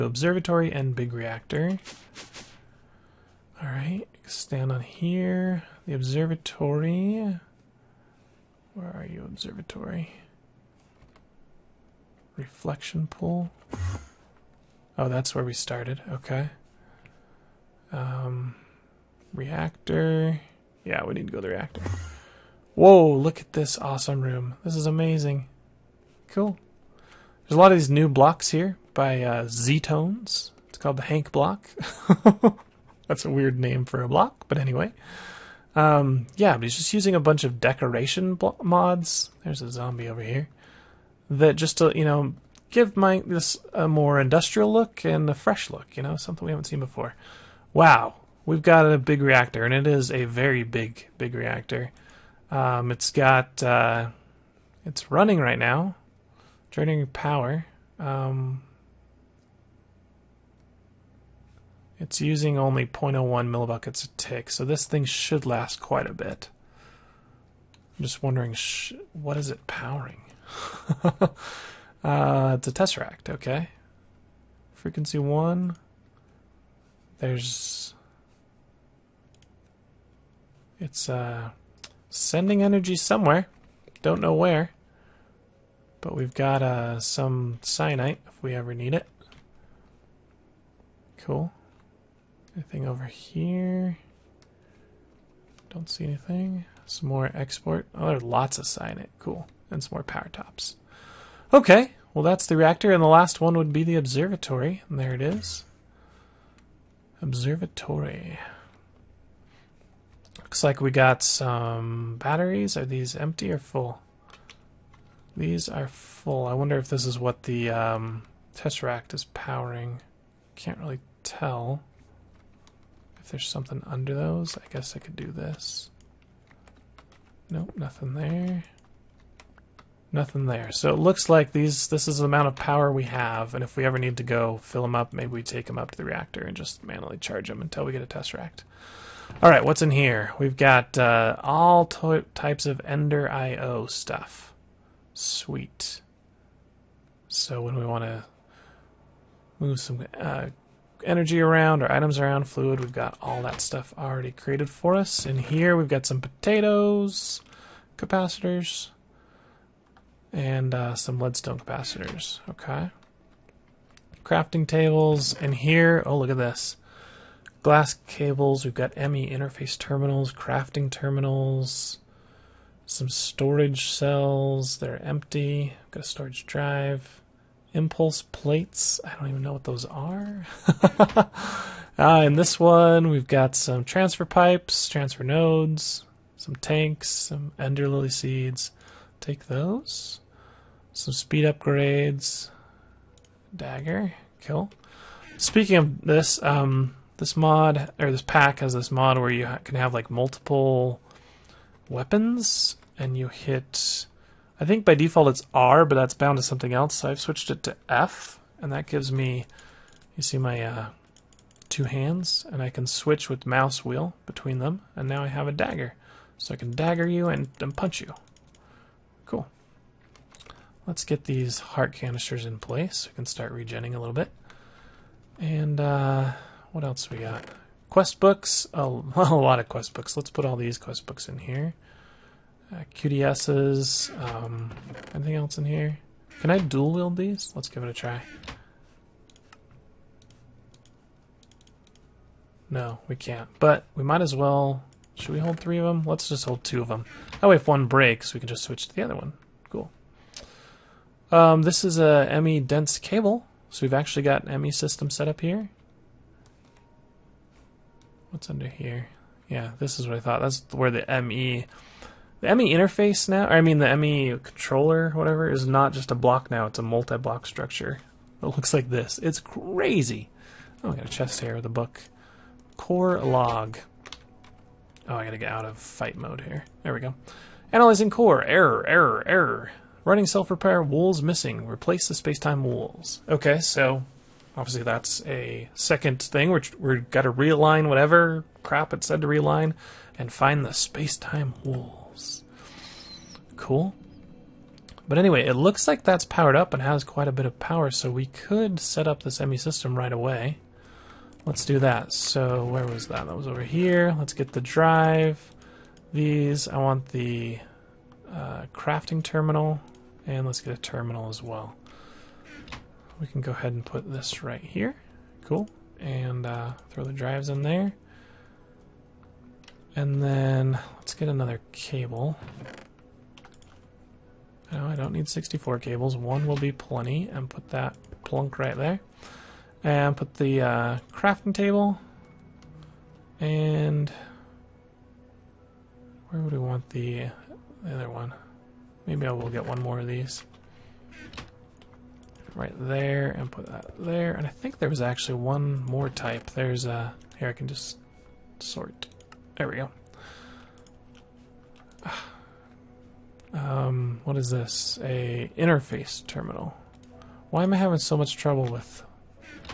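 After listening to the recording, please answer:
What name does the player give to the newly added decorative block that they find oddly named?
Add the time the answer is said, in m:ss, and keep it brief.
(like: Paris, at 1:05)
Hank block, at 0:31.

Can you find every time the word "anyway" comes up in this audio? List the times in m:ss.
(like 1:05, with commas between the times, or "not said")
0:34, 4:55.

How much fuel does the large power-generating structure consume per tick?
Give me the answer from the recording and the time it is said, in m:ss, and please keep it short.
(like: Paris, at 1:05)
0.01 millibuckets, at 1:02.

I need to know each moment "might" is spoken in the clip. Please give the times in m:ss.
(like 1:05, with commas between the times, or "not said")
4:04.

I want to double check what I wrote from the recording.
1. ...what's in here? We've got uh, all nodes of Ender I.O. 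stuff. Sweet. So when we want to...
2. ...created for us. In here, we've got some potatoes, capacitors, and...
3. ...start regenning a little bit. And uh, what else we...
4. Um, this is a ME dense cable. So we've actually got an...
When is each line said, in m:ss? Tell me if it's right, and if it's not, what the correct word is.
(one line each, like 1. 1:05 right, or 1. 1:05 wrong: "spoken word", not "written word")
1. 2:19 wrong: "types", not "nodes"
2. 2:34 right
3. 3:43 right
4. 4:11 right.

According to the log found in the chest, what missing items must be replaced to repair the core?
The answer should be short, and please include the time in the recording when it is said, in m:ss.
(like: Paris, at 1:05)
space-time wools, at 4:42.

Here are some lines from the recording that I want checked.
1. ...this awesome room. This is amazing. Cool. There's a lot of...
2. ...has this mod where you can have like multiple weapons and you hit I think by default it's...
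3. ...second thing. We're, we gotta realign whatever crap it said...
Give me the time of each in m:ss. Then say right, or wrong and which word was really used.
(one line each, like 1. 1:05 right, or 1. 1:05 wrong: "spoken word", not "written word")
1. 0:23 right
2. 3:18 right
3. 4:45 right.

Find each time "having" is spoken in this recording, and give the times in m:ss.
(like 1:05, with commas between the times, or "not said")
5:57.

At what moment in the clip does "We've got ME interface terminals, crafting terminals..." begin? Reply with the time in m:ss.
2:48.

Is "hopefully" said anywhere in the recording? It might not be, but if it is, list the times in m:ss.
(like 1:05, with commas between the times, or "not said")
not said.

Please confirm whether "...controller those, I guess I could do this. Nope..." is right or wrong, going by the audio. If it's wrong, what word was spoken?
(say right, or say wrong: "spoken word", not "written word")
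wrong: "under", not "controller".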